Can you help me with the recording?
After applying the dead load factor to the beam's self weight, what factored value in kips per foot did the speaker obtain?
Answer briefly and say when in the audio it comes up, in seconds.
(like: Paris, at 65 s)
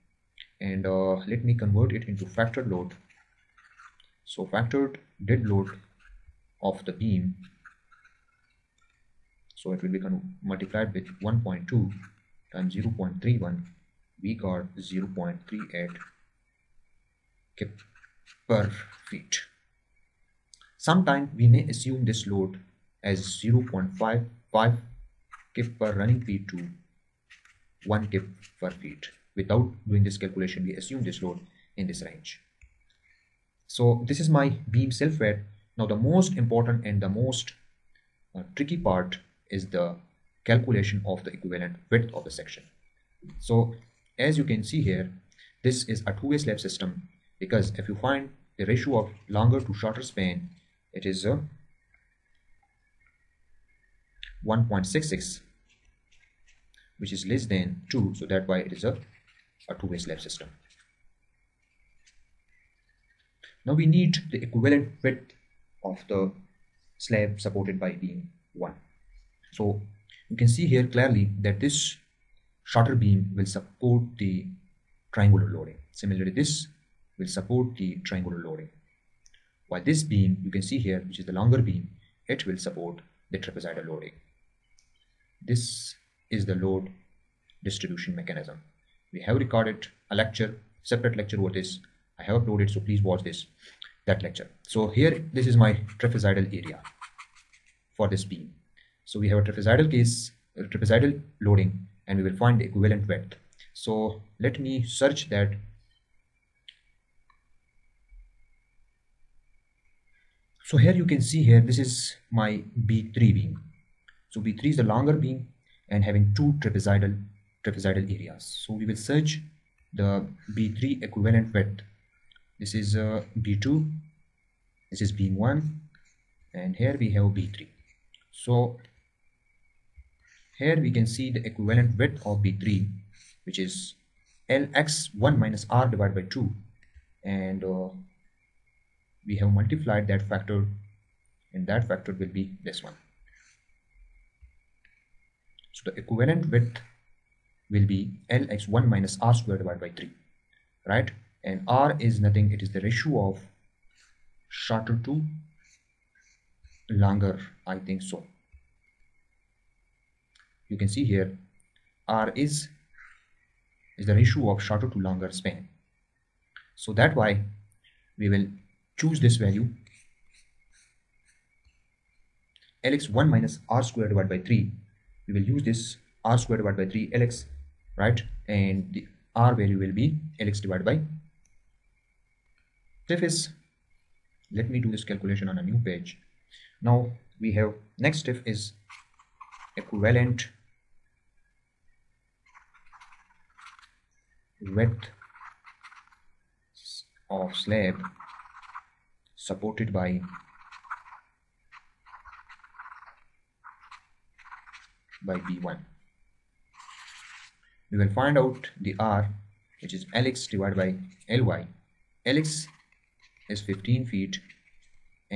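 0.38 kip per feet, at 14 s.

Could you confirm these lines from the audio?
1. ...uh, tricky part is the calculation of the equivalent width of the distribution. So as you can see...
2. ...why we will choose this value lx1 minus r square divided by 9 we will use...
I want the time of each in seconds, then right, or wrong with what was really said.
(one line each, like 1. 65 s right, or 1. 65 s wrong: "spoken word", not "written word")
1. 38 s wrong: "section", not "distribution"
2. 167 s wrong: "3", not "9".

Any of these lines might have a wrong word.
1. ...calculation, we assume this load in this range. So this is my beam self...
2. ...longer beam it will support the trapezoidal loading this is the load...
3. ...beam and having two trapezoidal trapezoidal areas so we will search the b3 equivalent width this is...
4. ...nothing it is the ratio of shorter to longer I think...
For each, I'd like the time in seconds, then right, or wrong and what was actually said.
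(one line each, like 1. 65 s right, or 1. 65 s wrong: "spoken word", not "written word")
1. 30 s right
2. 81 s right
3. 115 s right
4. 152 s right.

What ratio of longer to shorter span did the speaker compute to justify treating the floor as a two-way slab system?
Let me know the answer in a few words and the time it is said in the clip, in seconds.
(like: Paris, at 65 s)
1.66, at 54 s.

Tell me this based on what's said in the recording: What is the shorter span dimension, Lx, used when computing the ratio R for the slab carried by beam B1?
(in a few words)
15 feet.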